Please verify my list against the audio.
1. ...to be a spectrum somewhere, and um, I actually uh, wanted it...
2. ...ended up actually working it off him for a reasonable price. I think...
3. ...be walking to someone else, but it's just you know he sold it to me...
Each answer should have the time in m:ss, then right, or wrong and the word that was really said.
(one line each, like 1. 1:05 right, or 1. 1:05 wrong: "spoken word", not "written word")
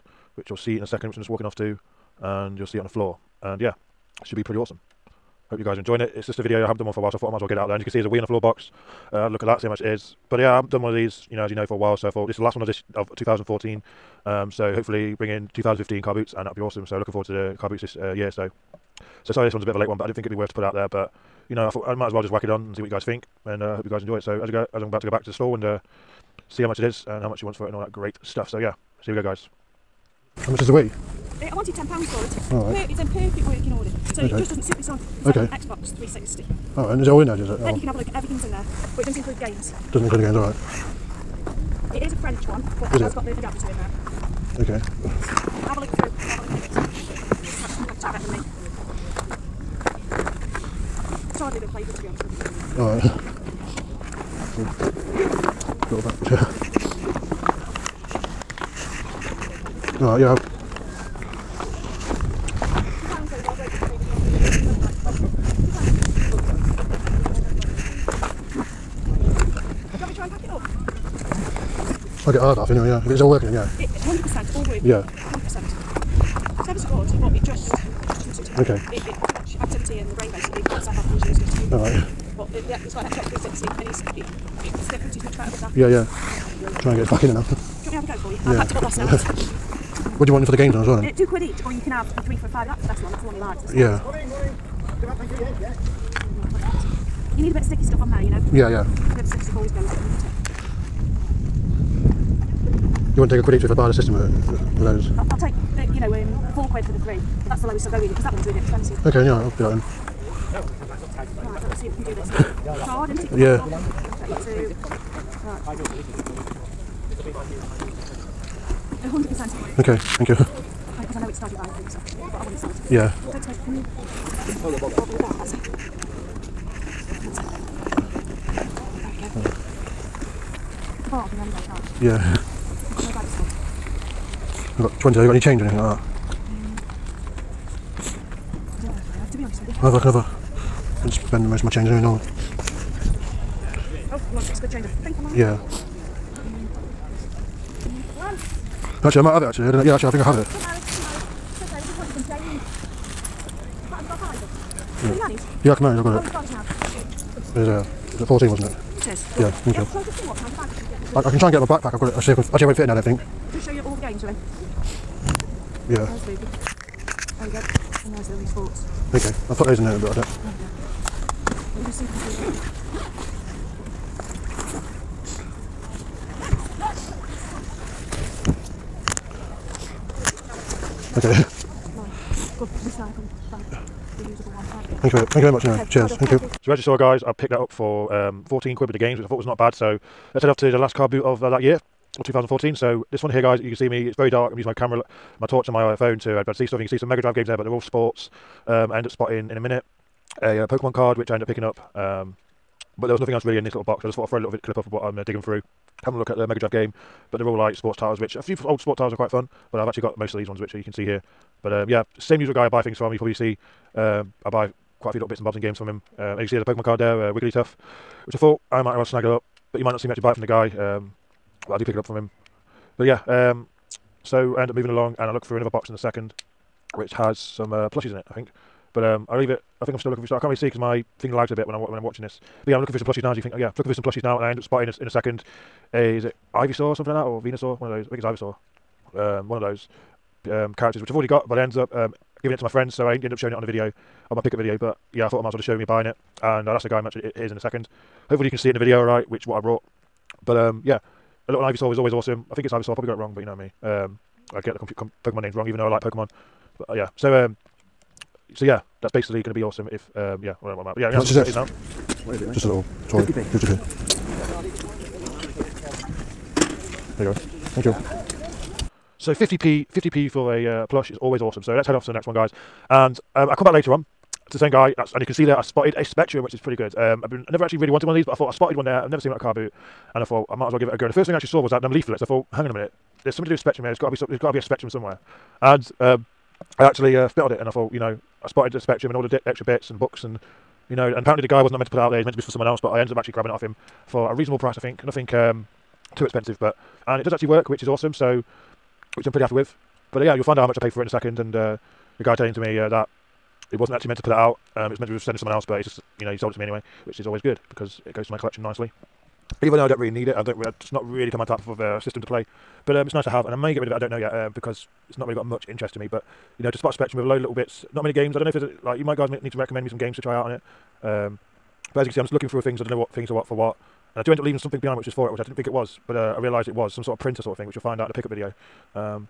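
1. 4:44 wrong: "spotted", not "wanted"
2. 4:53 wrong: "grabbing", not "working"
3. 5:05 wrong: "sending", not "walking".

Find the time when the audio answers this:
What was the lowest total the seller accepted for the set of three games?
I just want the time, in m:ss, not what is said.
1:46.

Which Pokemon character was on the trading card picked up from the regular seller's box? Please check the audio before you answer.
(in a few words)
Wigglytuff.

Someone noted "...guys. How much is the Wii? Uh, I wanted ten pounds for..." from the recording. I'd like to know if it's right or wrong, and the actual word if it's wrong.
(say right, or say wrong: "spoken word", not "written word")
right.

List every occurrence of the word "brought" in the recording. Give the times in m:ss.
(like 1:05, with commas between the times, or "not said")
4:09.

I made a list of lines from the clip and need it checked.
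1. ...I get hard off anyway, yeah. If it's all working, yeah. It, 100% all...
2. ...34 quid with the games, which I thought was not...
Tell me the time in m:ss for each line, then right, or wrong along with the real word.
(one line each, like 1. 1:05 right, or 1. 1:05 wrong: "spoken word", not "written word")
1. 1:12 right
2. 3:08 wrong: "14", not "34".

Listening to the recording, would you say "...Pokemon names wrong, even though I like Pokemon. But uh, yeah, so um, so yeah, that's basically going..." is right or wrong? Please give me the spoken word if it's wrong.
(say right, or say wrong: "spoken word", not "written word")
right.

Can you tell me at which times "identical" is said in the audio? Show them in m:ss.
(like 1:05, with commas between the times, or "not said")
not said.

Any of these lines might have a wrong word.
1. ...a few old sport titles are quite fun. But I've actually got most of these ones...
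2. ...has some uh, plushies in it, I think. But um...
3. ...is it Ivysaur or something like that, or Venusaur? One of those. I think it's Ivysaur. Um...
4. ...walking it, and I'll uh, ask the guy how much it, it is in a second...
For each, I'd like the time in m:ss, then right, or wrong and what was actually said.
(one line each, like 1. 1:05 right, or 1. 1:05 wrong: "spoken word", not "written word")
1. 3:28 right
2. 3:47 right
3. 3:56 right
4. 4:05 wrong: "buying", not "walking".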